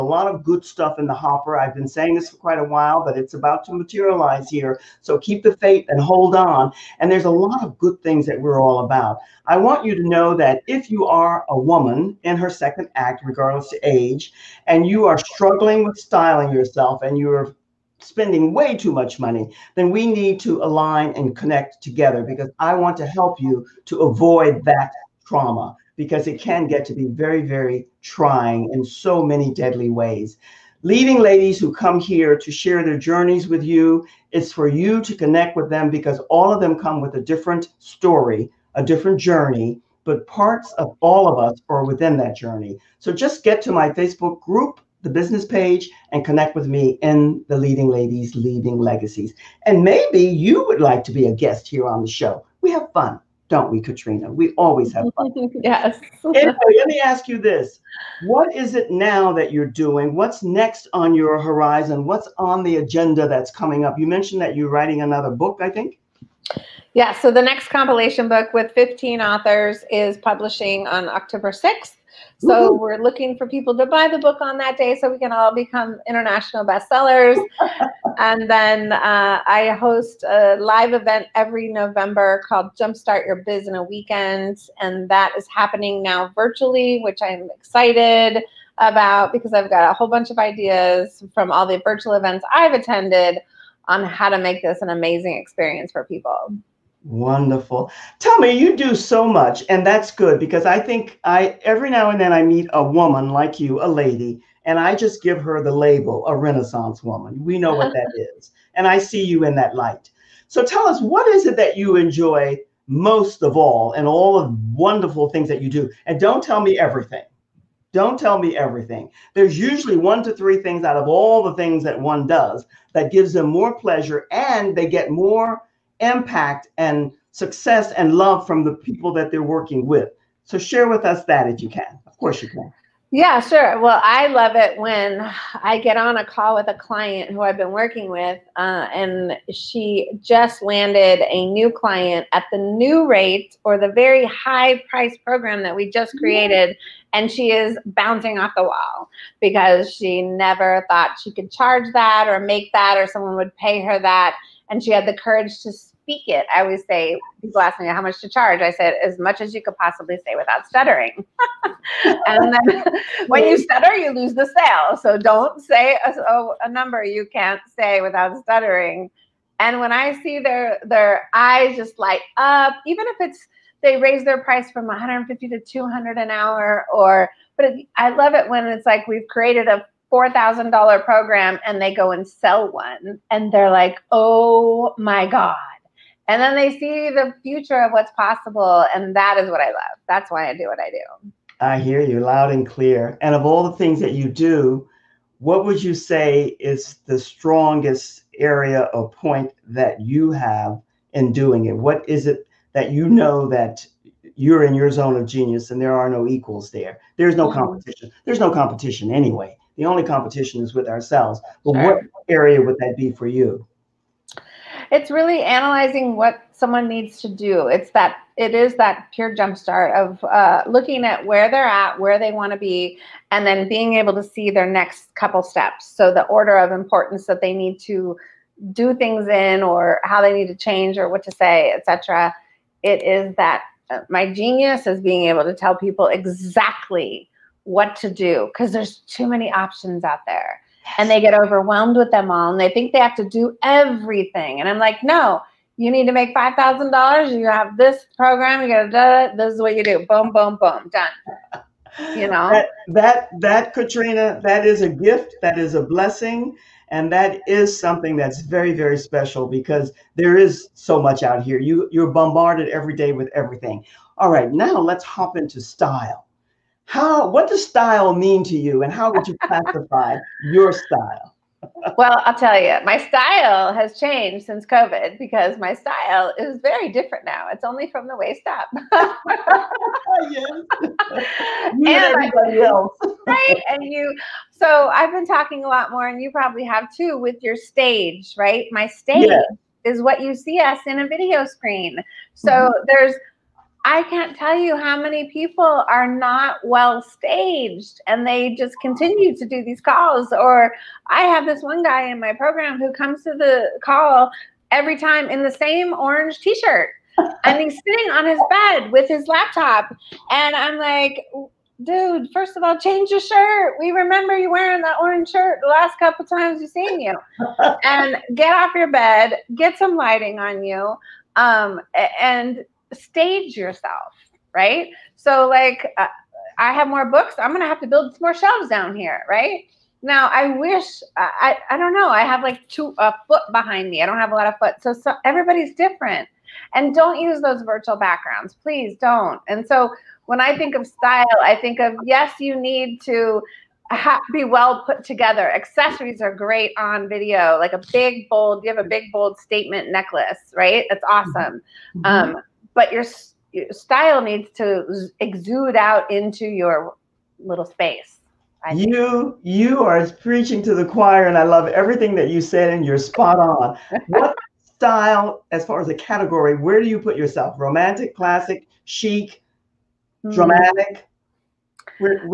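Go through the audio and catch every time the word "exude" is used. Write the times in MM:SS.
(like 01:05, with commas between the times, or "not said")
05:55.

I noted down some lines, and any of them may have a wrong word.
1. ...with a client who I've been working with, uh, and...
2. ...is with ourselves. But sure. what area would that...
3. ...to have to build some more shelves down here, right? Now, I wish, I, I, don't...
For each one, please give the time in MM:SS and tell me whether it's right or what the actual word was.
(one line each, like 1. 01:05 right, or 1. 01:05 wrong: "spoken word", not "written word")
1. 02:16 right
2. 03:30 right
3. 05:27 right.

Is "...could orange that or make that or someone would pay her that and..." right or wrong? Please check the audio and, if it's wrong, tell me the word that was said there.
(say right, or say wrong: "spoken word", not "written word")
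wrong: "charge", not "orange".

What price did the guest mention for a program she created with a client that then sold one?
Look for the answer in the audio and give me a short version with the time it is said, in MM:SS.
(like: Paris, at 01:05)
$4,000, at 03:00.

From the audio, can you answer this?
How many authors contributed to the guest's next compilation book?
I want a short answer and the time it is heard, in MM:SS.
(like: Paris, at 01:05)
15, at 01:08.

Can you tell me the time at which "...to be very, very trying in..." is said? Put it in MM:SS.
00:26.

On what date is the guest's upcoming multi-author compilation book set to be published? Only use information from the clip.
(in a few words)
October 6th.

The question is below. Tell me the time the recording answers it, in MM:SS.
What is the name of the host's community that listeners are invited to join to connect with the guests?
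00:47.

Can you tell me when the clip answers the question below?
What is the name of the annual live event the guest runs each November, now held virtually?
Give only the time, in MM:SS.
01:22.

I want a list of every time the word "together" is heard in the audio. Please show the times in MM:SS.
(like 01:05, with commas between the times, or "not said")
00:21, 05:45.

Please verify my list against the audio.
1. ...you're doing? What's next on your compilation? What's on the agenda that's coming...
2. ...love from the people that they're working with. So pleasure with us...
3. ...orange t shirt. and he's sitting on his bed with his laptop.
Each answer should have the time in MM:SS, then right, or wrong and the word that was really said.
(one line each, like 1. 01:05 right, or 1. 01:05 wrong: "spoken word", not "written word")
1. 00:59 wrong: "horizon", not "compilation"
2. 02:08 wrong: "share", not "pleasure"
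3. 05:05 right.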